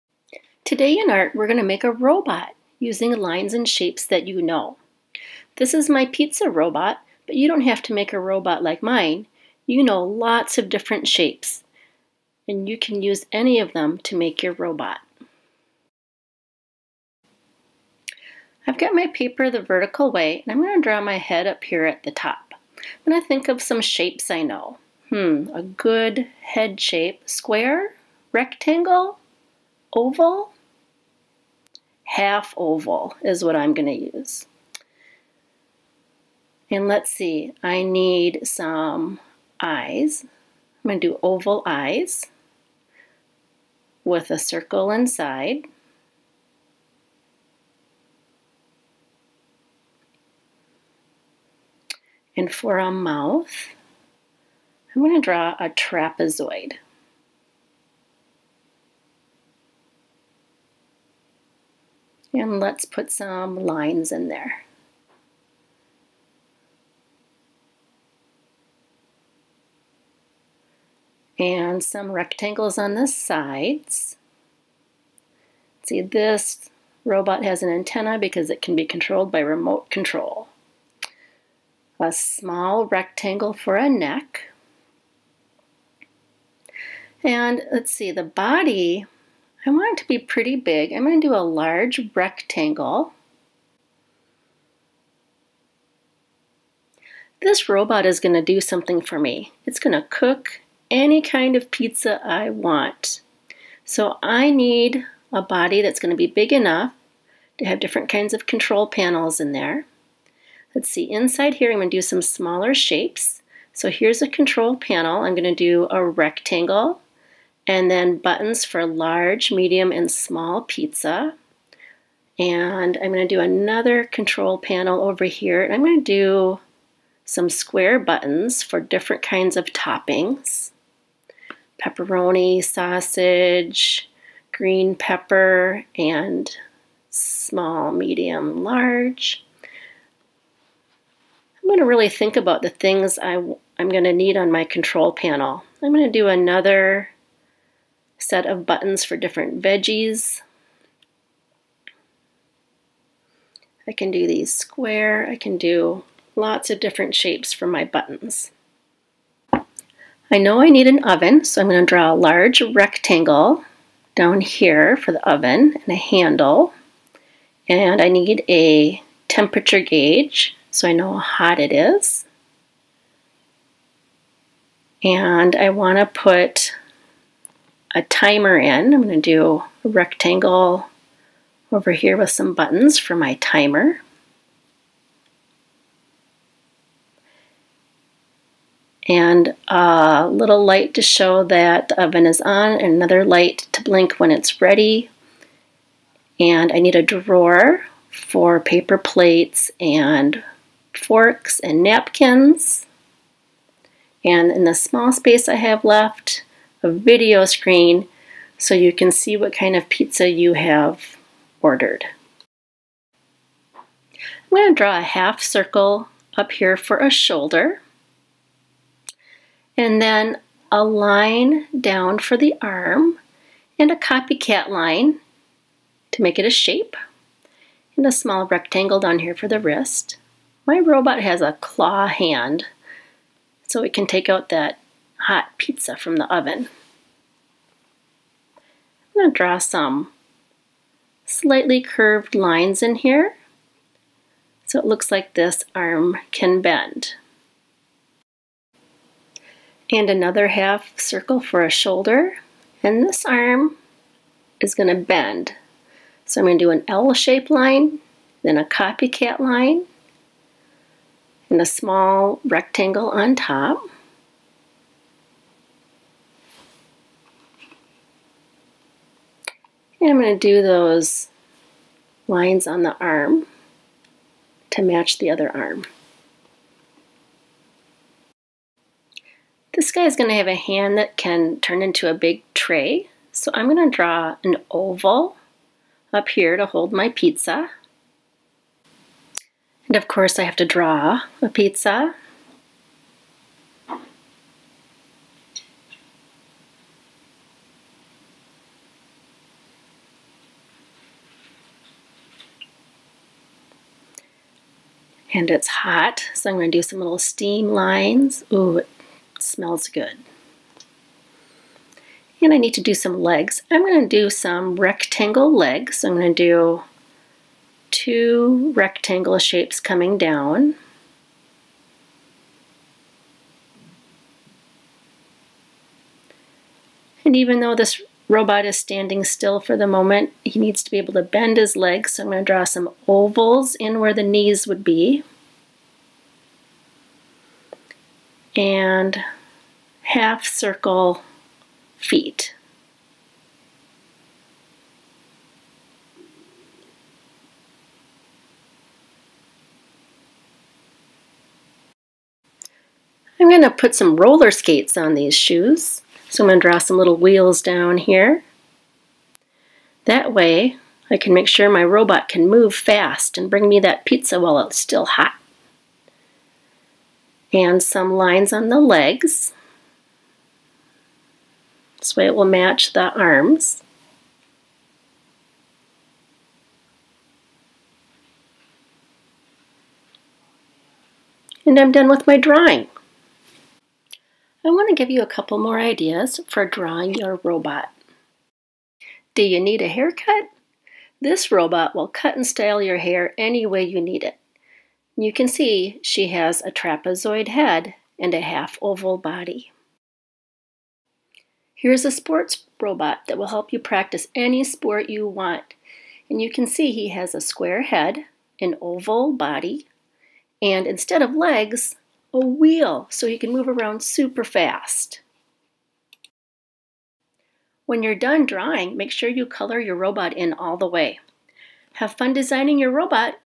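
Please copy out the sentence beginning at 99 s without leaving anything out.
It's going to cook any kind of pizza I want.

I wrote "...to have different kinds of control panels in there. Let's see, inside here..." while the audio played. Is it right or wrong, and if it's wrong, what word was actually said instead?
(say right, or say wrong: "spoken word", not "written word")
right.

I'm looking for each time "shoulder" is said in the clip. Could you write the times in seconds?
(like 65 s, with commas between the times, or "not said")
217 s, 251 s.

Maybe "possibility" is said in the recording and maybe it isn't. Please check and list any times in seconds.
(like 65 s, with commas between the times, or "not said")
not said.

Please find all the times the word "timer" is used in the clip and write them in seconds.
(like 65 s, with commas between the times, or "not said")
178 s, 183 s.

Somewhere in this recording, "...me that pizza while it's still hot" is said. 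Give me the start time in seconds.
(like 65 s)
363 s.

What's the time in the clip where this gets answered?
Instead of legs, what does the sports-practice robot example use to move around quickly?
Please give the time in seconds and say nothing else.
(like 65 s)
412 s.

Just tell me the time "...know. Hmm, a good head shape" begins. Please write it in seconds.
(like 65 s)
24 s.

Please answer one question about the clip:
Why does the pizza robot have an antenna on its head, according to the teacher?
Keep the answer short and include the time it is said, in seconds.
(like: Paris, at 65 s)
Remote control, at 79 s.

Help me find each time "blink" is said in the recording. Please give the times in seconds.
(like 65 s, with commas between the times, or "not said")
193 s.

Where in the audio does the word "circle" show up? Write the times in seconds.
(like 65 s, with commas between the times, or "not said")
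44 s, 215 s, 250 s, 340 s.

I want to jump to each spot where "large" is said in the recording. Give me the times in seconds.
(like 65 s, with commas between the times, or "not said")
91 s, 118 s, 138 s, 162 s.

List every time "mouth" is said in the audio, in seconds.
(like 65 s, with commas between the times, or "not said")
52 s.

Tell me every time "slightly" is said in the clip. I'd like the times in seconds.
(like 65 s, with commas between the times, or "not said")
241 s.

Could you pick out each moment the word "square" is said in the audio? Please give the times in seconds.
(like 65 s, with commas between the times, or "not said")
27 s, 127 s, 154 s, 407 s.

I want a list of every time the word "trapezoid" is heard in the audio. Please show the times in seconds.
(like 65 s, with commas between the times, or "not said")
55 s, 396 s.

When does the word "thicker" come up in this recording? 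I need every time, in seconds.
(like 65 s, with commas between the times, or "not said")
not said.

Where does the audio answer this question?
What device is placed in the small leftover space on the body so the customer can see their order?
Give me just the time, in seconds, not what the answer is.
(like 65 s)
206 s.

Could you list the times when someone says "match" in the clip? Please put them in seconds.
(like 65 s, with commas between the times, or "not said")
274 s, 372 s.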